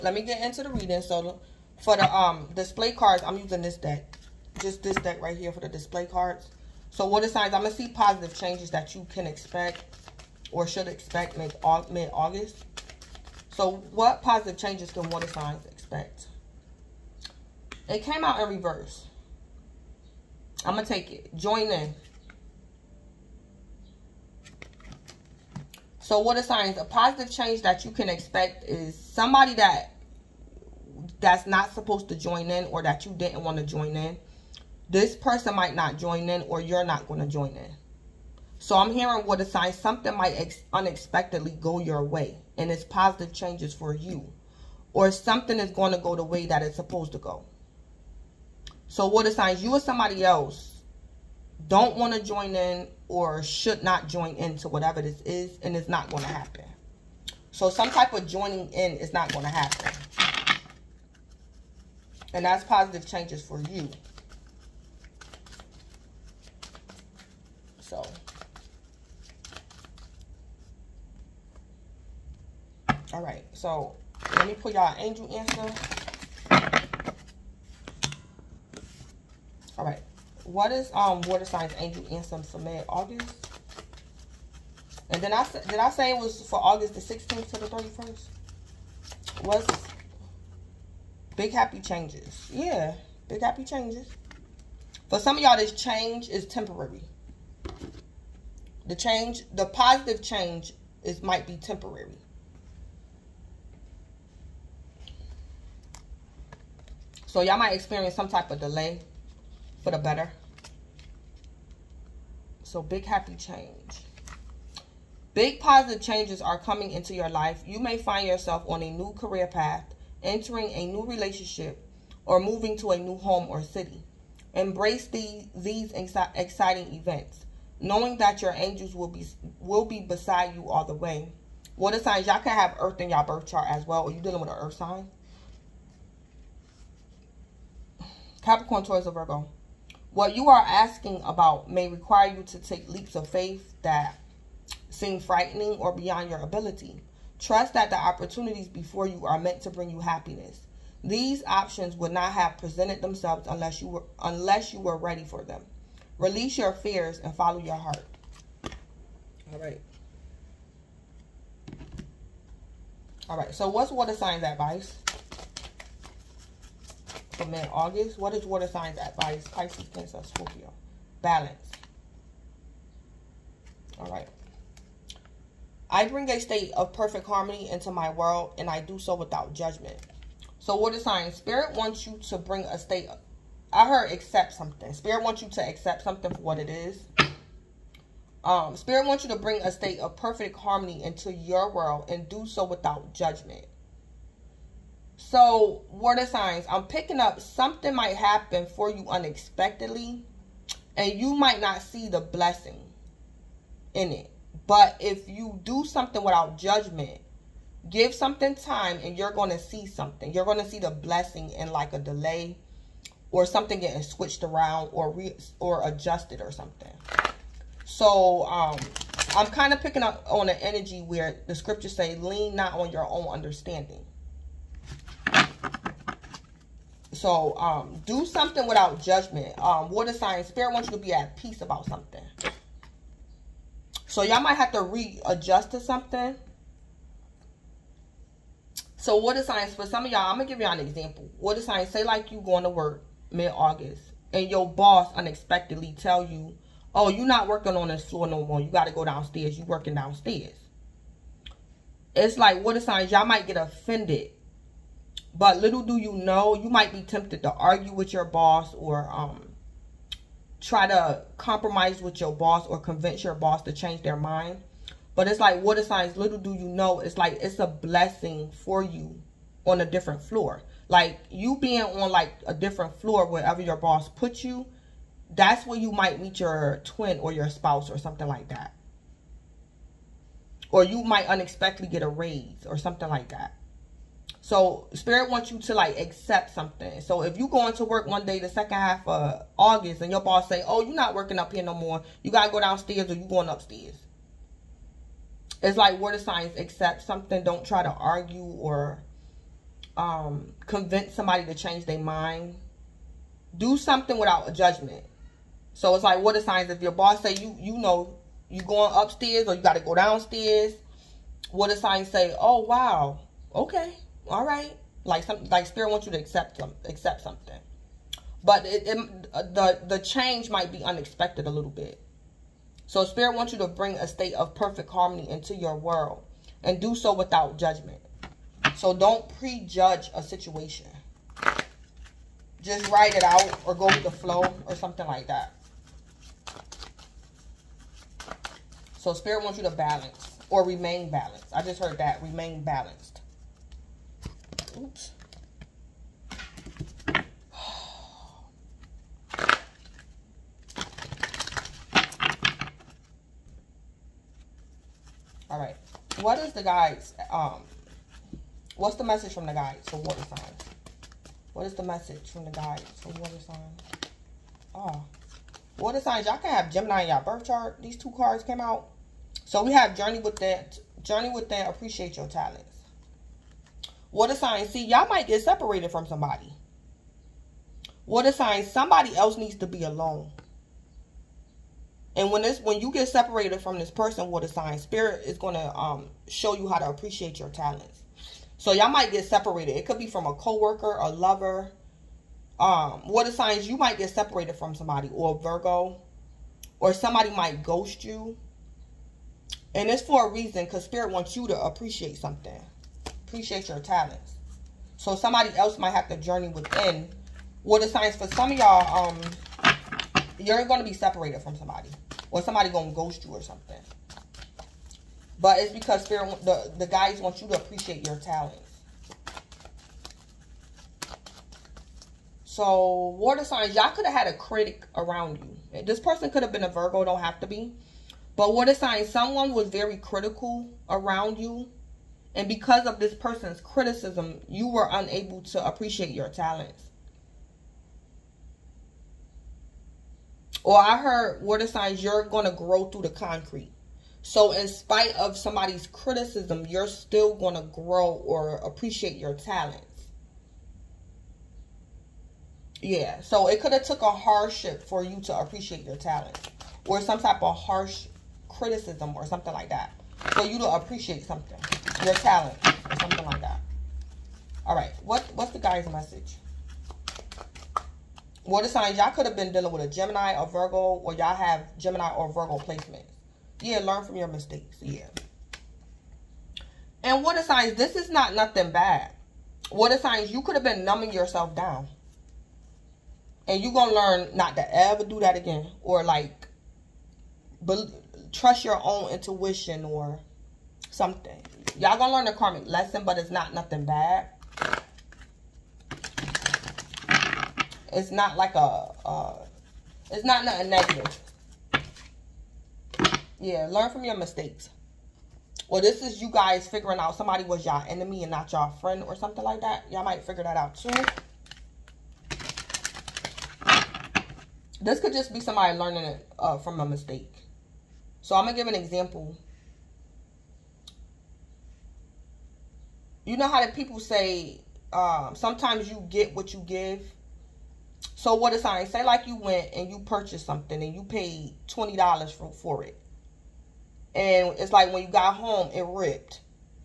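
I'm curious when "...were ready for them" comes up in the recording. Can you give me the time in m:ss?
2:34.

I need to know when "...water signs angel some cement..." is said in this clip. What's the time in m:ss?
1:21.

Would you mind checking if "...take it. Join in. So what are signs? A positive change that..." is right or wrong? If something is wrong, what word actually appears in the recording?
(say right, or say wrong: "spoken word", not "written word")
right.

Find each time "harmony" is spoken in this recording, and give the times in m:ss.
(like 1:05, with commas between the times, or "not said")
2:57, 3:10, 5:24.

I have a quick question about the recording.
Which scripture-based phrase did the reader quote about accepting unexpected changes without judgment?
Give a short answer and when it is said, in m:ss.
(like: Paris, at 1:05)
Lean not on your own understanding, at 3:42.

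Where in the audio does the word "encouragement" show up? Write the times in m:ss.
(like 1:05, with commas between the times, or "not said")
not said.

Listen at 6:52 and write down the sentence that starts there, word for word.
Or somebody going to ghost you or something.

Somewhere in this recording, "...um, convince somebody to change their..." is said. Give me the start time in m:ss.
4:59.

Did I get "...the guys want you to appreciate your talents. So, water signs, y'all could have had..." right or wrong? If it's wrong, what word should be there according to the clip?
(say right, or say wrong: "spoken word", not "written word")
right.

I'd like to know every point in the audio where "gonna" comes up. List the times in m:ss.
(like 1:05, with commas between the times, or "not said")
6:25, 8:11.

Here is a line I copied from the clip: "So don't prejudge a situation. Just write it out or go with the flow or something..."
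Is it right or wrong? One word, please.
right.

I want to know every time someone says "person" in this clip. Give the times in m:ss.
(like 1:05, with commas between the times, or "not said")
0:35, 6:23, 7:05, 7:13.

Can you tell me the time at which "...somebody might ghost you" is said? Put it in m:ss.
6:36.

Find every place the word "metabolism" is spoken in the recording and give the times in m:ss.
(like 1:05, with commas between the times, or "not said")
not said.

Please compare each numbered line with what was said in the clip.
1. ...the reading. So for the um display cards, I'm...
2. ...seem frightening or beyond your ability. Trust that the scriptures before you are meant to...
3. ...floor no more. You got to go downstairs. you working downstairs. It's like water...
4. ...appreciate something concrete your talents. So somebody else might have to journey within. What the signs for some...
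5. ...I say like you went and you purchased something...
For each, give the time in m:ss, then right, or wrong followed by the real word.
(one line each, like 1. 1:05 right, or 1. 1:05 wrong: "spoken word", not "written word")
1. 0:00 right
2. 2:24 wrong: "opportunities", not "scriptures"
3. 4:08 right
4. 6:41 wrong: "appreciate", not "concrete"
5. 8:48 right.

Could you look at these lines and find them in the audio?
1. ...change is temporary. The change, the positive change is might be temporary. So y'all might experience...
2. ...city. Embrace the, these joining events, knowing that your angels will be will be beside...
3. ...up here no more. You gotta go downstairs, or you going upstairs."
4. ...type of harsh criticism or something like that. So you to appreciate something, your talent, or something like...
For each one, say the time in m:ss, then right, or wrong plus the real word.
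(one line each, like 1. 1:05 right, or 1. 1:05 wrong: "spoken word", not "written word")
1. 1:35 right
2. 2:03 wrong: "exciting", not "joining"
3. 4:51 right
4. 7:37 right.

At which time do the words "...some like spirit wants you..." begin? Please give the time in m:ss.
5:15.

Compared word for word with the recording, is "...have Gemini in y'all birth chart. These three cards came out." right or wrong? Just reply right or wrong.
wrong.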